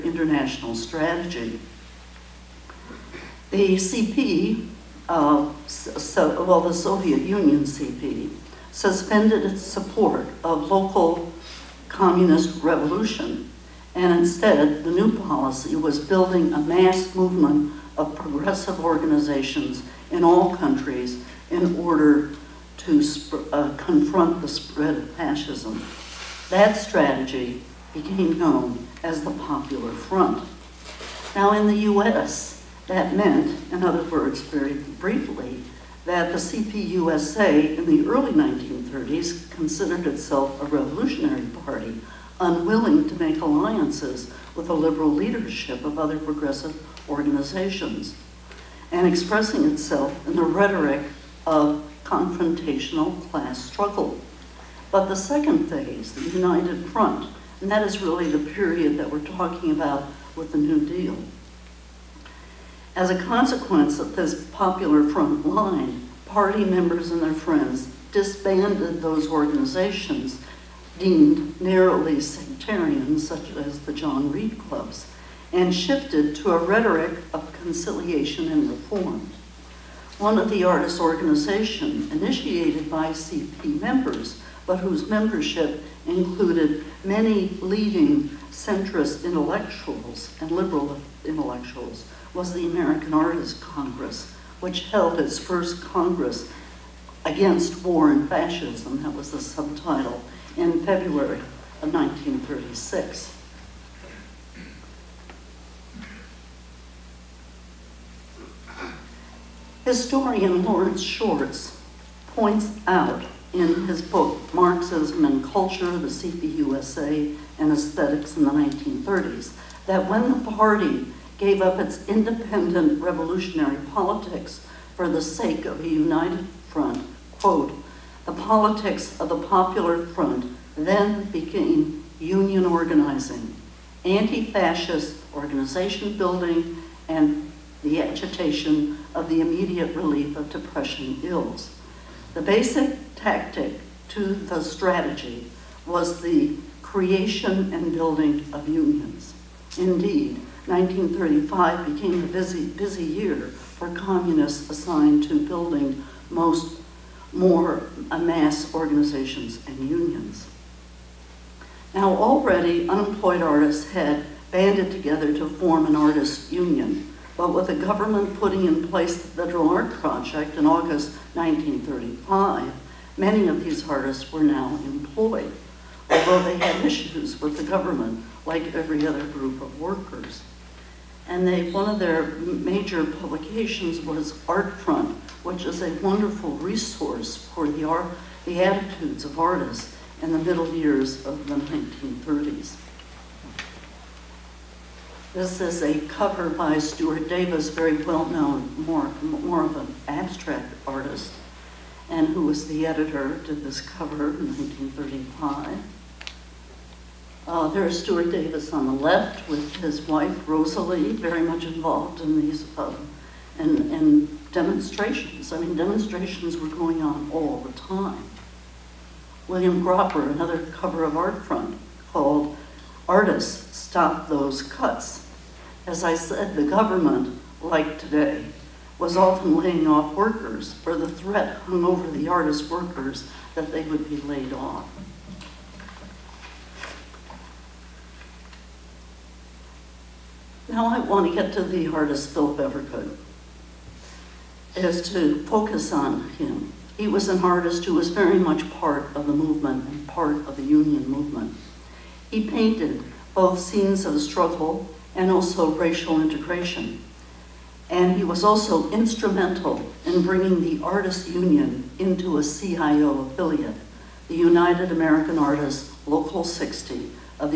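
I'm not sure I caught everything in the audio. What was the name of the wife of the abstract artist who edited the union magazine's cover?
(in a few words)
Roselle.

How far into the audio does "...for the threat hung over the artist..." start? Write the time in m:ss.
3:50.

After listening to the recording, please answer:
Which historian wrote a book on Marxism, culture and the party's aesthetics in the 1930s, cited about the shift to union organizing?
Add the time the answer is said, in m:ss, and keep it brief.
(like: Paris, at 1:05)
Lawrence Schwartz, at 1:50.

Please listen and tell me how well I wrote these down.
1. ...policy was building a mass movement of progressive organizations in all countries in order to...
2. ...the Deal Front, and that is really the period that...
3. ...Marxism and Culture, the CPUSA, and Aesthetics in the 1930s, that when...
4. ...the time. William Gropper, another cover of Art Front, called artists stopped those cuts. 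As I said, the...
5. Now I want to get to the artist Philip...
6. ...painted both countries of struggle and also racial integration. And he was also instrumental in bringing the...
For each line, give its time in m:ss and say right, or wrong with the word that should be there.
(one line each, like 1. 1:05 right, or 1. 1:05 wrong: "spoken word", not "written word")
1. 0:15 right
2. 0:56 wrong: "United", not "Deal"
3. 1:54 right
4. 3:37 right
5. 4:00 right
6. 4:12 wrong: "scenes", not "countries".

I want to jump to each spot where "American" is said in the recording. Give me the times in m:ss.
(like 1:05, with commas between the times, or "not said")
1:32, 4:24.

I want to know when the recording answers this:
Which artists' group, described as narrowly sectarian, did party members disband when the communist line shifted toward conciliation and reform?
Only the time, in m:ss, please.
1:13.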